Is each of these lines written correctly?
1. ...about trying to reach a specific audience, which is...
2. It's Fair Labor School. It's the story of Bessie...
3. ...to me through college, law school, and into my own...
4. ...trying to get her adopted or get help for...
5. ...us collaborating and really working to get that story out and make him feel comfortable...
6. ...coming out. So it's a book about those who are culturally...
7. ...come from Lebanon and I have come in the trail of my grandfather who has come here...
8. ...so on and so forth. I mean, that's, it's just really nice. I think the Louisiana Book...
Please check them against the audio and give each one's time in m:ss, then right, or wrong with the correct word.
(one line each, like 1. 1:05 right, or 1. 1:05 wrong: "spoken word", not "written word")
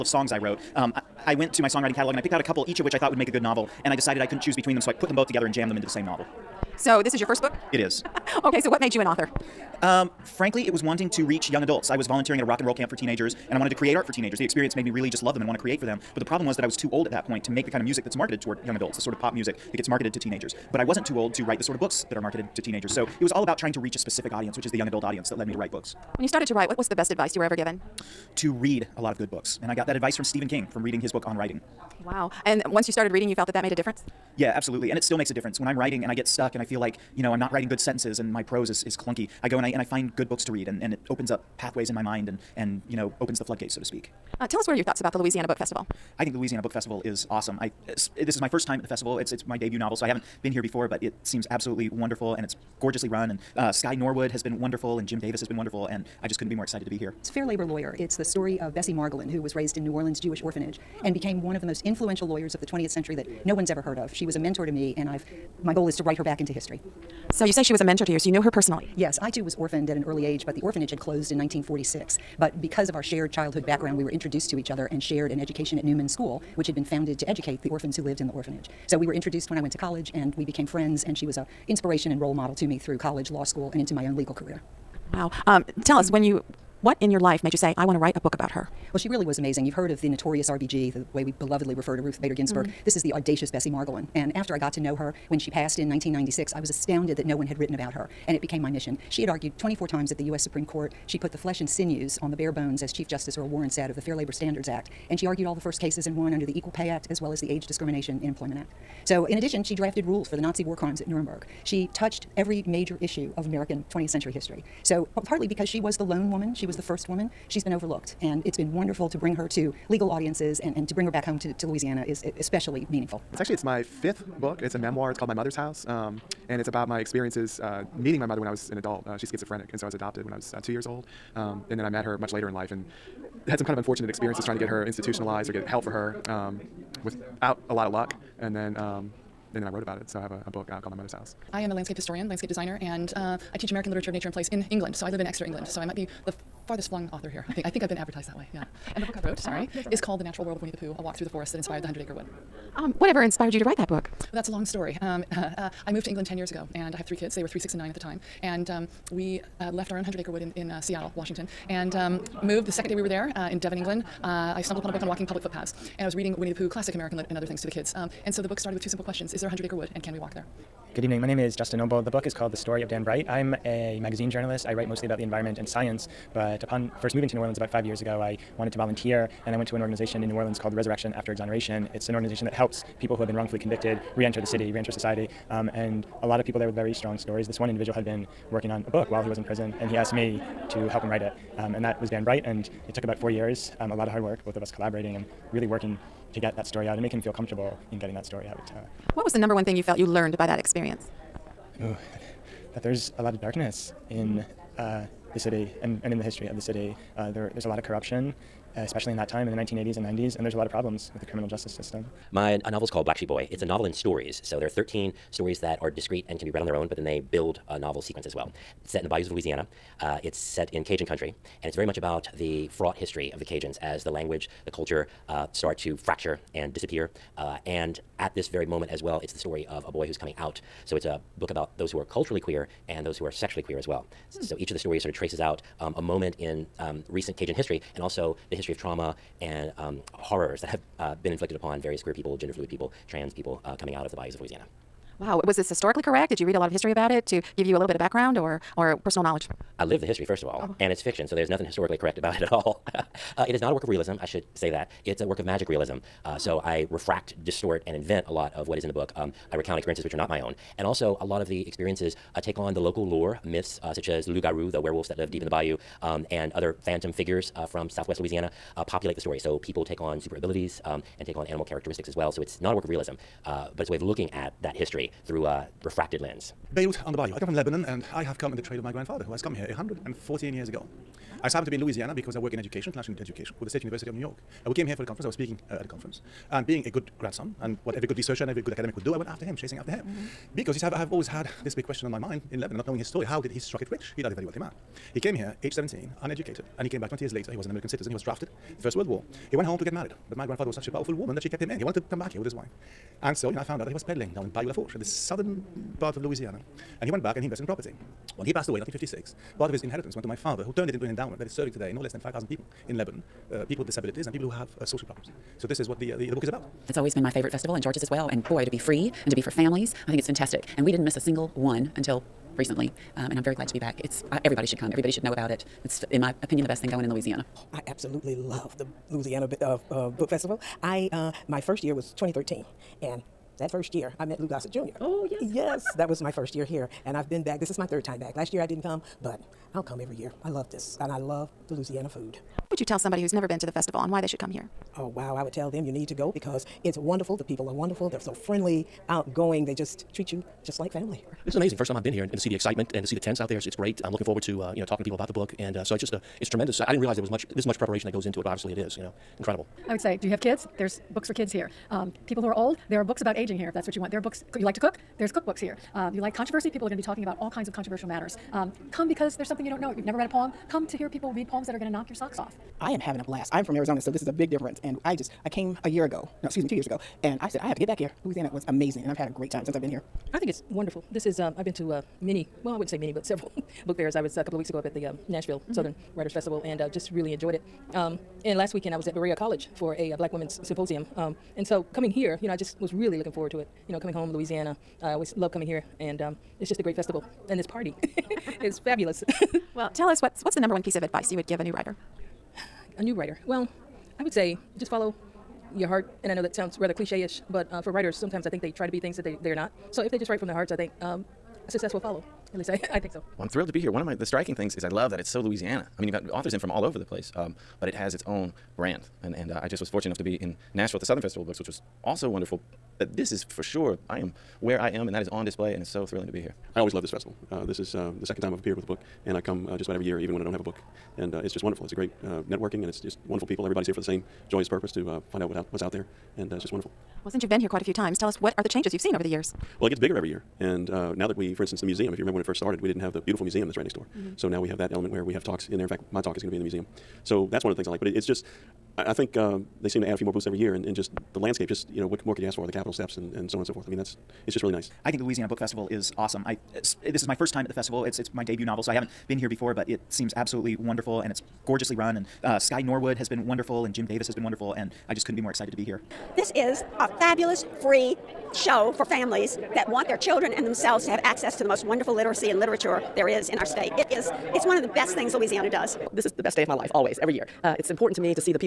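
1. 0:23 right
2. 0:57 wrong: "Lawyer", not "School"
3. 1:22 right
4. 2:14 wrong: "institutionalized", not "adopted"
5. 3:14 right
6. 3:50 right
7. 4:37 right
8. 7:33 right.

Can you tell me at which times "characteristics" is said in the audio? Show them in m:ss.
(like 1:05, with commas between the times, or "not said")
4:31.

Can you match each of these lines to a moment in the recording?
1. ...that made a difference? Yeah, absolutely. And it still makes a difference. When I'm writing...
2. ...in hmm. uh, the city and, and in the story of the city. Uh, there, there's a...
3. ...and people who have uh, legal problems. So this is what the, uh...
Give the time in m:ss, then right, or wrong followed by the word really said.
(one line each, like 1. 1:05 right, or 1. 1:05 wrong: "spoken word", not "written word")
1. 0:33 right
2. 3:24 wrong: "history", not "story"
3. 5:14 wrong: "social", not "legal".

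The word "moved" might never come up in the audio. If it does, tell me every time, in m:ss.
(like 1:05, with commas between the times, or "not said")
2:35, 2:42.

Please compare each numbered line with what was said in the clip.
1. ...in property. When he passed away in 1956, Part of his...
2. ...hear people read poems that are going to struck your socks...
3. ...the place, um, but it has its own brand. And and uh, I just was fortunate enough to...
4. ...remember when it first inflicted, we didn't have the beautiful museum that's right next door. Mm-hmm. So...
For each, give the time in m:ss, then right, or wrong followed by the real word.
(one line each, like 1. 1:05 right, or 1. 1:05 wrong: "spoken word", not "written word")
1. 5:07 right
2. 6:10 wrong: "knock", not "struck"
3. 6:56 right
4. 7:22 wrong: "started", not "inflicted".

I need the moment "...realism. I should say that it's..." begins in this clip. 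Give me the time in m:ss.
4:13.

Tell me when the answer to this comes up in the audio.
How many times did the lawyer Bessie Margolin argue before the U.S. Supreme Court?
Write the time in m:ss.
1:39.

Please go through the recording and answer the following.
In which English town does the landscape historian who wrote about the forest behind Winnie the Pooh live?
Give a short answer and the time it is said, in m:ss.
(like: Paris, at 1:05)
Exeter, at 2:25.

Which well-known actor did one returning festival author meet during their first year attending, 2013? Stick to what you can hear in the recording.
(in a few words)
Lou Gossett Jr.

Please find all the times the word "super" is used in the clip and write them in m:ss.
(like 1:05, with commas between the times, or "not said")
4:30.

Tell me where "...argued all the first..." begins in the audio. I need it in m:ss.
1:45.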